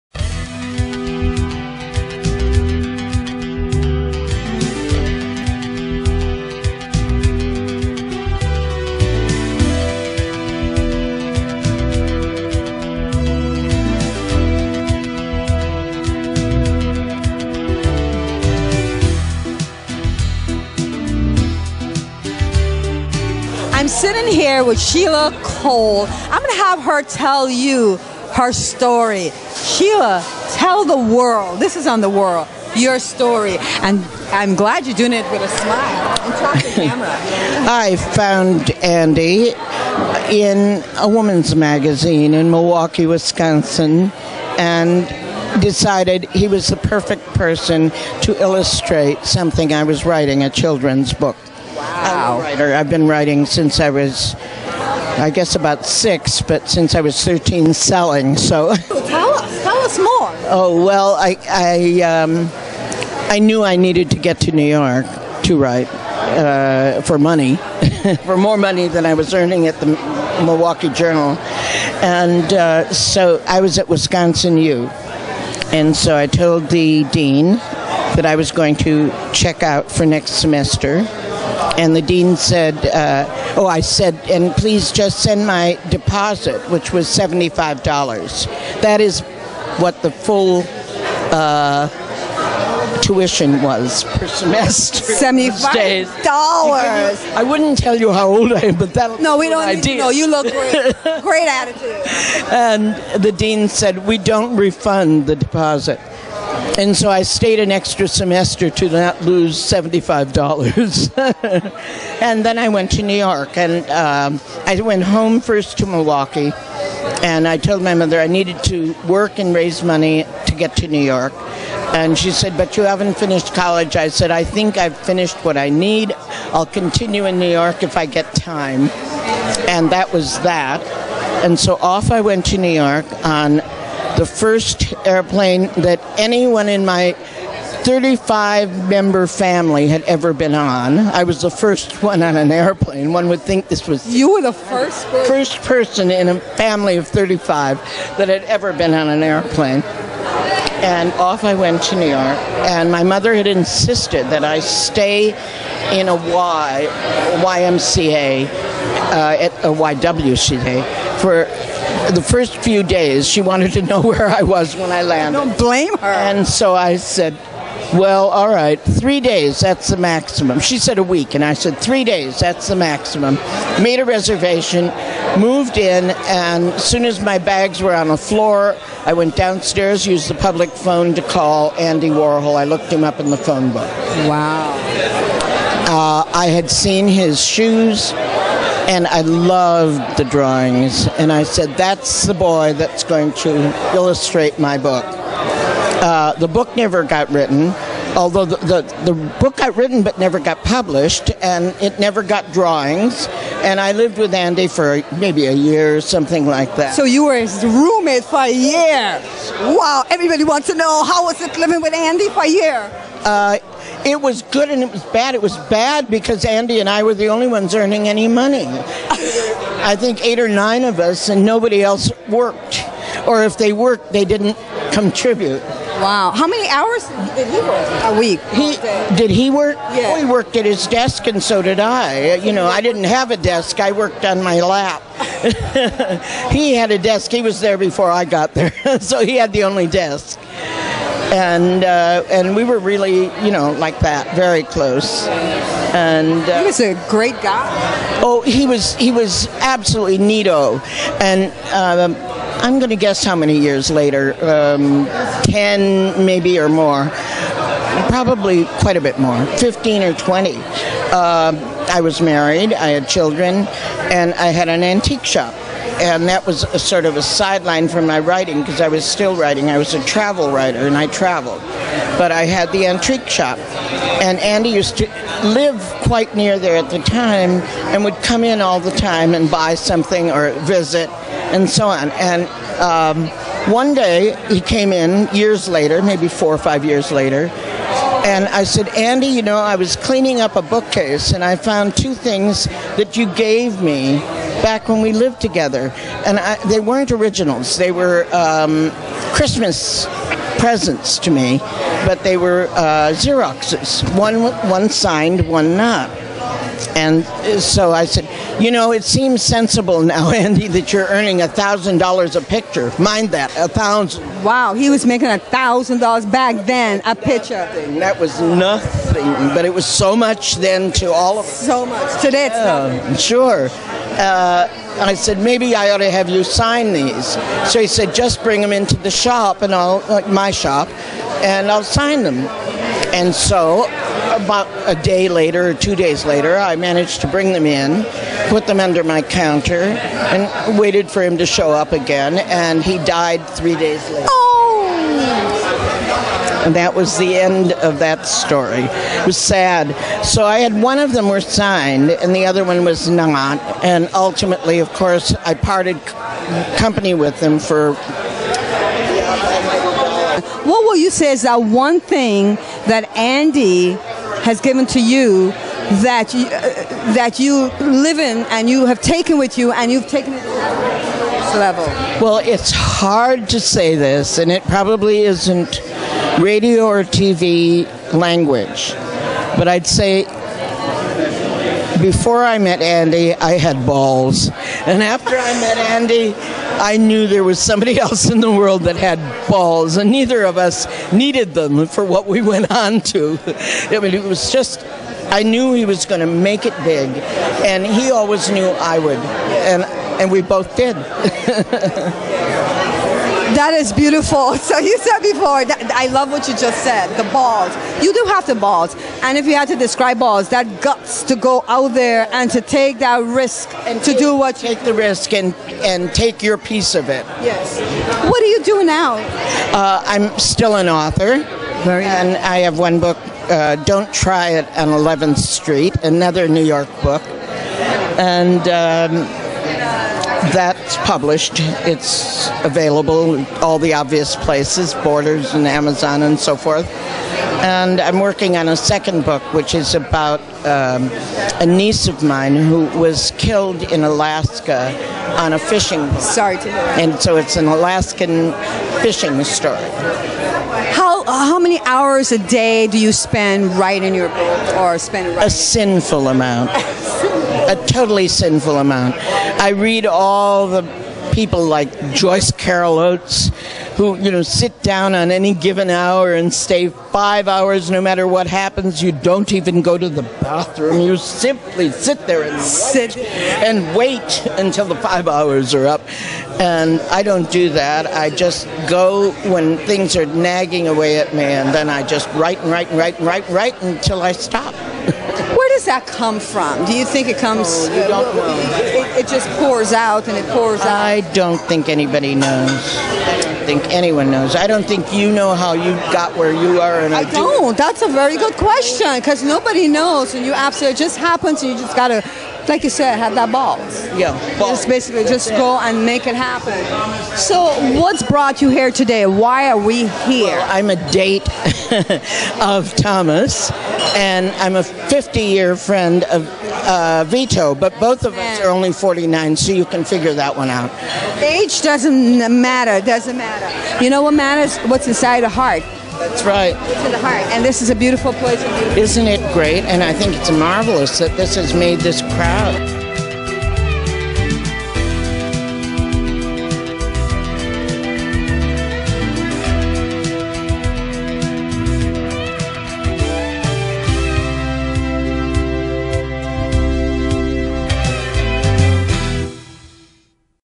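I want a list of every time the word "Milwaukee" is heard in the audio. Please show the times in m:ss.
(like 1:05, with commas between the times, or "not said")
0:42, 1:10, 1:55.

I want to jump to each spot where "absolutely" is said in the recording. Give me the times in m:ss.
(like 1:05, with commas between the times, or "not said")
4:09, 8:20.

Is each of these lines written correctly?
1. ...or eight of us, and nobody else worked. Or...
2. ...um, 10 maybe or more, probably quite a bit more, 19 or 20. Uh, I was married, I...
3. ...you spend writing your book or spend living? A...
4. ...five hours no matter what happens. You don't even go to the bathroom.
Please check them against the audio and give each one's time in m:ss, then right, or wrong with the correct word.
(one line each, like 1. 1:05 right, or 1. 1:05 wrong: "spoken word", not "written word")
1. 3:40 wrong: "nine", not "eight"
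2. 4:14 wrong: "15", not "19"
3. 7:32 wrong: "writing", not "living"
4. 7:46 right.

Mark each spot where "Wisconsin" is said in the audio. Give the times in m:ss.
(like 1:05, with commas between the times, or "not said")
0:43, 1:13.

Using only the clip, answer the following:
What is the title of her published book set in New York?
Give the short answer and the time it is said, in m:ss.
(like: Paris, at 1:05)
Don't Try It on 11th Street, at 7:03.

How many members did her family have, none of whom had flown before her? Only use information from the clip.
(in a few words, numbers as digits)
35.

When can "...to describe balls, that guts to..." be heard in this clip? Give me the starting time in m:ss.
6:49.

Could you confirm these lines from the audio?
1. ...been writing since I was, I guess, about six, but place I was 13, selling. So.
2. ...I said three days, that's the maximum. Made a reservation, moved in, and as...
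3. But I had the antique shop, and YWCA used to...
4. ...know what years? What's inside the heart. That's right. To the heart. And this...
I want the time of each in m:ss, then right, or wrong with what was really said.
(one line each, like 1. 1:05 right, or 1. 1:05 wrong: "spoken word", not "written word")
1. 0:52 wrong: "since", not "place"
2. 2:51 right
3. 4:32 wrong: "Andy", not "YWCA"
4. 8:44 wrong: "matters", not "years".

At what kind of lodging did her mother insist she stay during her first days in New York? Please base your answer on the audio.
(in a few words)
YWCA.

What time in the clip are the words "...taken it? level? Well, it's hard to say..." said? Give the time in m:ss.
6:10.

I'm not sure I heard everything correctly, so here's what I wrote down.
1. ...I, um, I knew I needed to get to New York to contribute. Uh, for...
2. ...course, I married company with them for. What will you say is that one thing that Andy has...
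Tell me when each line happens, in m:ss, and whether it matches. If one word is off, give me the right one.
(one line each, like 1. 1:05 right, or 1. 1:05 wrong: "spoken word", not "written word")
1. 1:01 wrong: "write", not "contribute"
2. 5:54 wrong: "parted", not "married".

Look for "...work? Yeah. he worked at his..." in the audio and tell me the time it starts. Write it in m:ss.
3:49.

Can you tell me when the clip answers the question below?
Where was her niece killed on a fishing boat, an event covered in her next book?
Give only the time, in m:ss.
7:24.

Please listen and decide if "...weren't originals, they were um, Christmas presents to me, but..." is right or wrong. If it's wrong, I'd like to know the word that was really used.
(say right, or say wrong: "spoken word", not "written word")
right.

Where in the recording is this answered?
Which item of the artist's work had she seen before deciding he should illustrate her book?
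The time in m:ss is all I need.
3:07.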